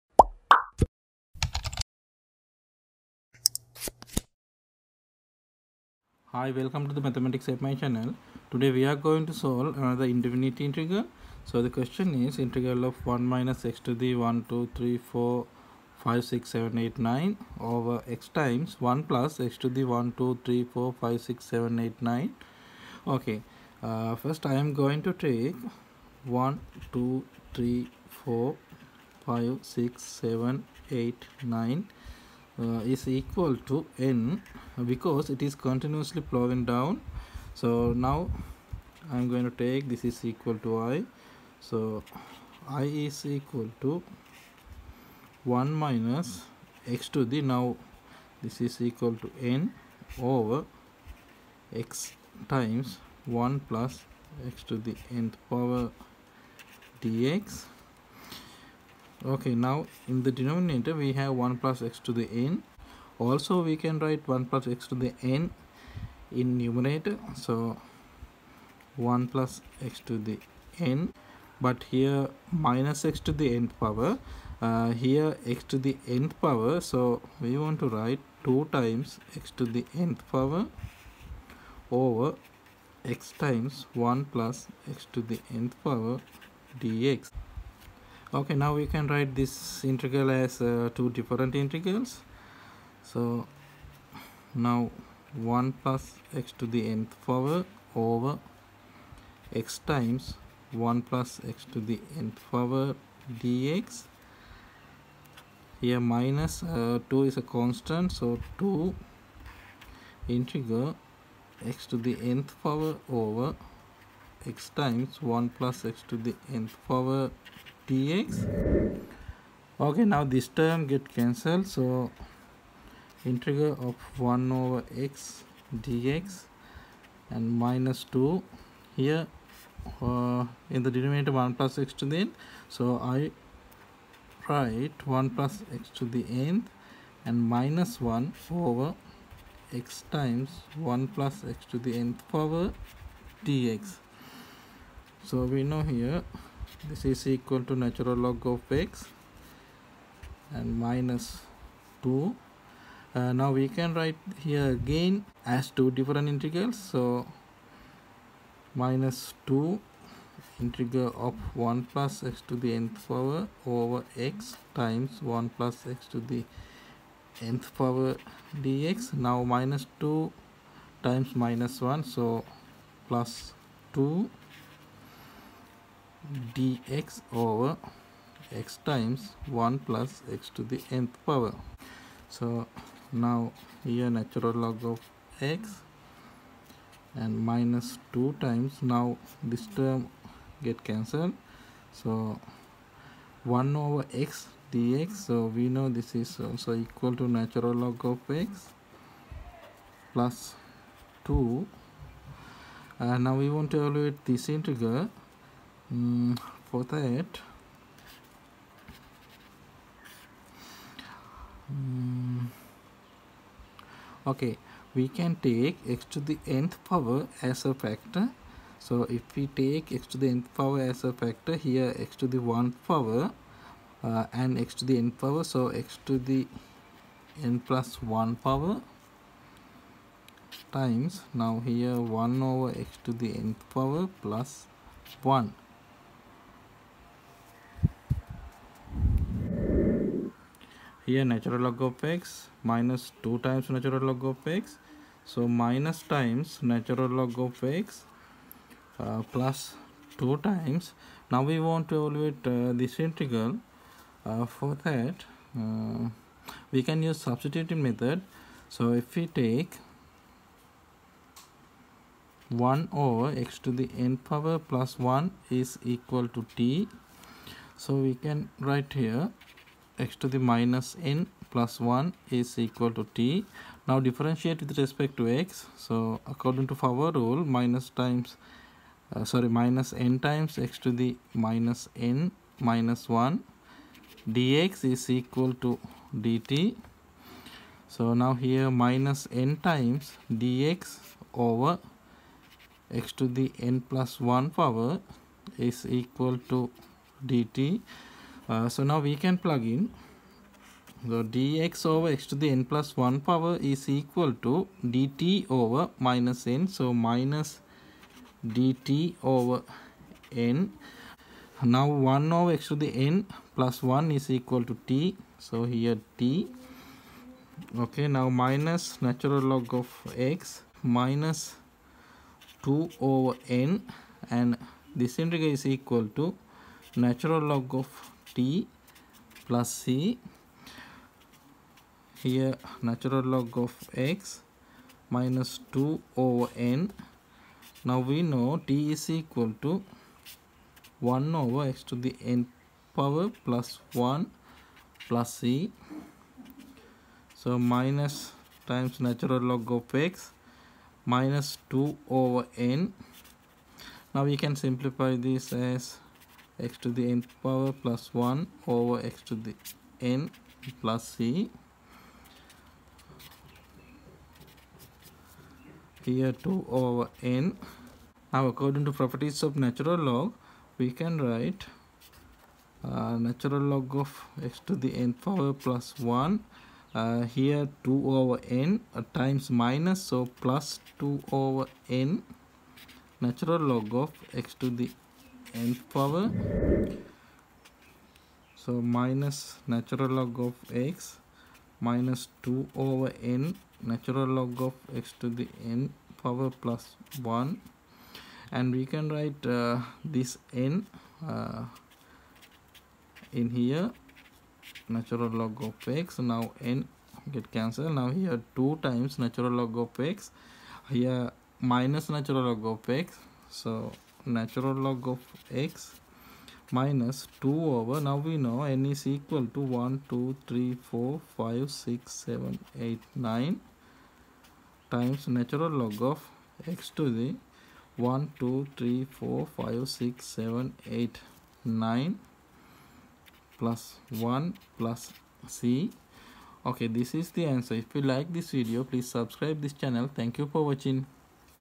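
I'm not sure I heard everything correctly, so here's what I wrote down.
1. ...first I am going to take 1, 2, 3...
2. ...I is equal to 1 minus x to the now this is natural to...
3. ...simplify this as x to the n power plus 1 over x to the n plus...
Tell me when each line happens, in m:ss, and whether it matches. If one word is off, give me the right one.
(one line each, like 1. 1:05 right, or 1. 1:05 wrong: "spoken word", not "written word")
1. 0:24 right
2. 0:42 wrong: "equal", not "natural"
3. 5:54 right.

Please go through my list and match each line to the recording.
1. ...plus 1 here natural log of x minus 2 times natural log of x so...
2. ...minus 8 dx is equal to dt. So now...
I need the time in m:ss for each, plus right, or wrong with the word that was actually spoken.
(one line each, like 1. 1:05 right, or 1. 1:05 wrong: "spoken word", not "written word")
1. 3:54 right
2. 4:42 wrong: "1", not "8".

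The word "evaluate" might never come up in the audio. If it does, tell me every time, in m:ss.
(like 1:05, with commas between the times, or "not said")
3:23, 4:12.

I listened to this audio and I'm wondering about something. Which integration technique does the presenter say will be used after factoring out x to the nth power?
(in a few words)
substituting method.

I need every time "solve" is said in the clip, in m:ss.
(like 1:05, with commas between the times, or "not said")
0:09.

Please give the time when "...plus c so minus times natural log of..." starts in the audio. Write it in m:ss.
5:45.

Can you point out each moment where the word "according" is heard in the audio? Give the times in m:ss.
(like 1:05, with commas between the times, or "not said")
4:36, 6:08.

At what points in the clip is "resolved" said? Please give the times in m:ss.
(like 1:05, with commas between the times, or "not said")
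not said.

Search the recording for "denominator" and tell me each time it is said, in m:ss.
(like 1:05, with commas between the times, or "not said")
1:00, 2:10.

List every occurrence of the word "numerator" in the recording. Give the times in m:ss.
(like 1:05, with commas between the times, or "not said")
1:06.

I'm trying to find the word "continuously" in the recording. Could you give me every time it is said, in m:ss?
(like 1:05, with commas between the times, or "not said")
0:35.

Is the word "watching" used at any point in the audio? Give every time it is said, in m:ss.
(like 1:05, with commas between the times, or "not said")
7:20.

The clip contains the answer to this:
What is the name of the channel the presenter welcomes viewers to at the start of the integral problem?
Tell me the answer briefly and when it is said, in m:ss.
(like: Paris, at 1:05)
Mathematics MI, at 0:07.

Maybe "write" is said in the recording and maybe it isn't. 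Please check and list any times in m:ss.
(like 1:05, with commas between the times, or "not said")
1:03, 1:17, 1:29, 2:14, 2:33, 4:28, 6:11, 6:39.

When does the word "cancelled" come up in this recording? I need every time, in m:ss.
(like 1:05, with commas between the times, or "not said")
2:01, 3:10, 6:47.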